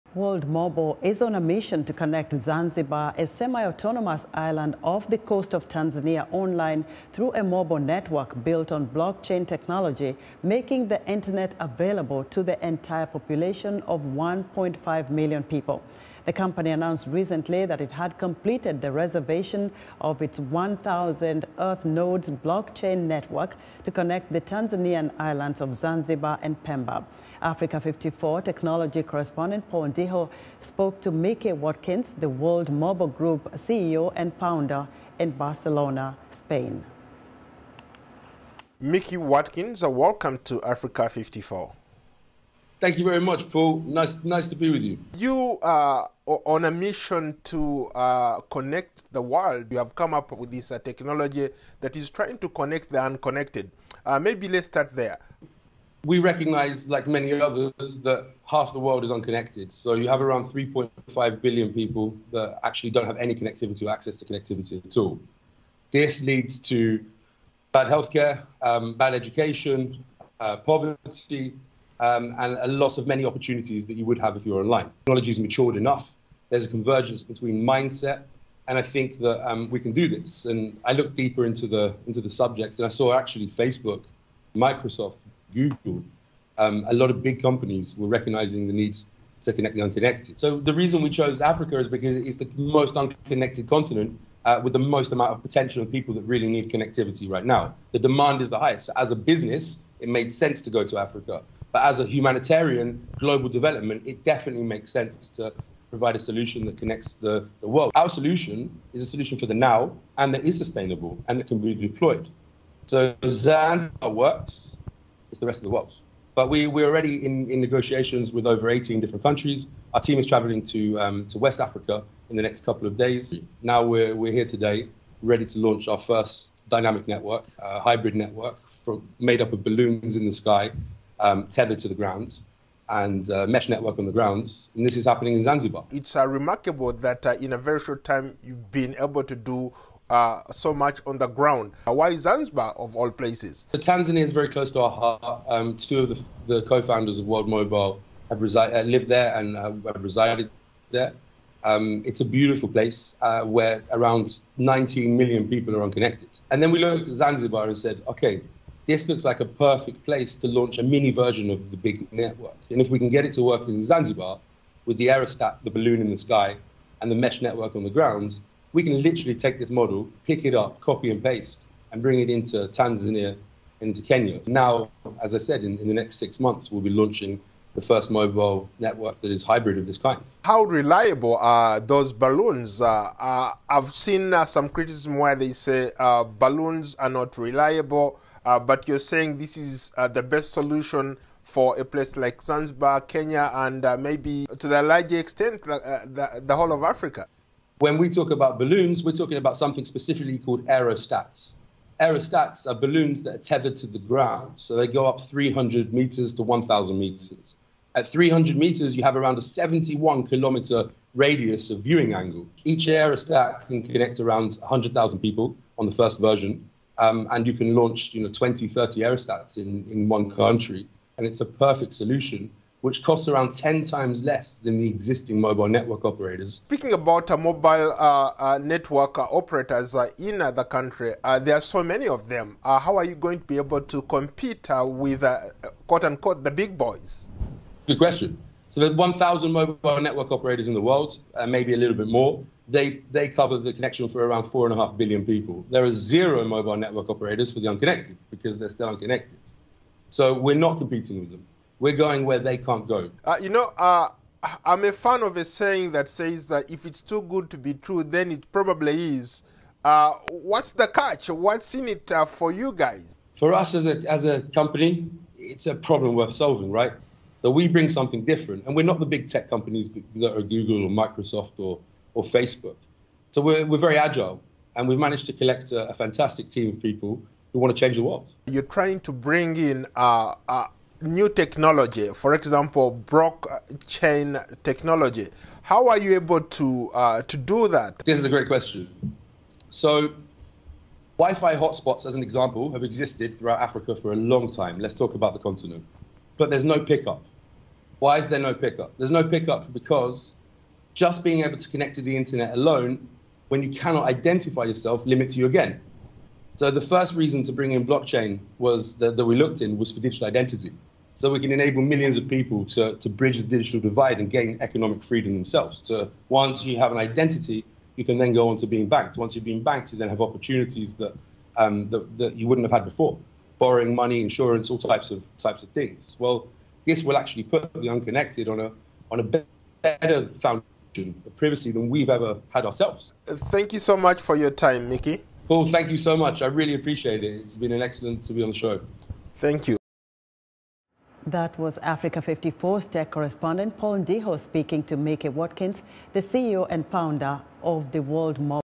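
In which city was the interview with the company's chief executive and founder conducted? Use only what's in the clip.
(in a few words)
Barcelona.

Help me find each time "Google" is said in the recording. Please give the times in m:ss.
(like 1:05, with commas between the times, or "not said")
1:25, 4:30.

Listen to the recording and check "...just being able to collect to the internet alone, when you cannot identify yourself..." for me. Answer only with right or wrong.
wrong.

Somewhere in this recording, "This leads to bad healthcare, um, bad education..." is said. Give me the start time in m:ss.
1:05.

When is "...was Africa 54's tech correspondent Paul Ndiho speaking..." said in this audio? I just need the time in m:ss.
5:41.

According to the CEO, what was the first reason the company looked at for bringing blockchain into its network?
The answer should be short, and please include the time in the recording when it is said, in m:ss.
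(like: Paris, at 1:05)
Digital identity, at 5:09.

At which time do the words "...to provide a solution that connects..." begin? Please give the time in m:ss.
1:45.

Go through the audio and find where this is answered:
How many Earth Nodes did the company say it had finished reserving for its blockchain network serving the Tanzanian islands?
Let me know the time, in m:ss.
0:20.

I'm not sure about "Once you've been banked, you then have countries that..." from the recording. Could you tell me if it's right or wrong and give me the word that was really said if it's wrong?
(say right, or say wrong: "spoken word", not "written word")
wrong: "opportunities", not "countries".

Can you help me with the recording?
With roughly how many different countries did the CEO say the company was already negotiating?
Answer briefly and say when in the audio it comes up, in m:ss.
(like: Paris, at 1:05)
18, at 1:58.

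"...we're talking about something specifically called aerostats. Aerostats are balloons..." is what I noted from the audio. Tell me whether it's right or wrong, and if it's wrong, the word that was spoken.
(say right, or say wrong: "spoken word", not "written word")
right.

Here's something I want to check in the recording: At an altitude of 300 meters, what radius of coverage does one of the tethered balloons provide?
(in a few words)
71 kilometers.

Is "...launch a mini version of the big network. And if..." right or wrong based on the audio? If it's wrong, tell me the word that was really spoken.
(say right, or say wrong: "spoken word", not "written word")
right.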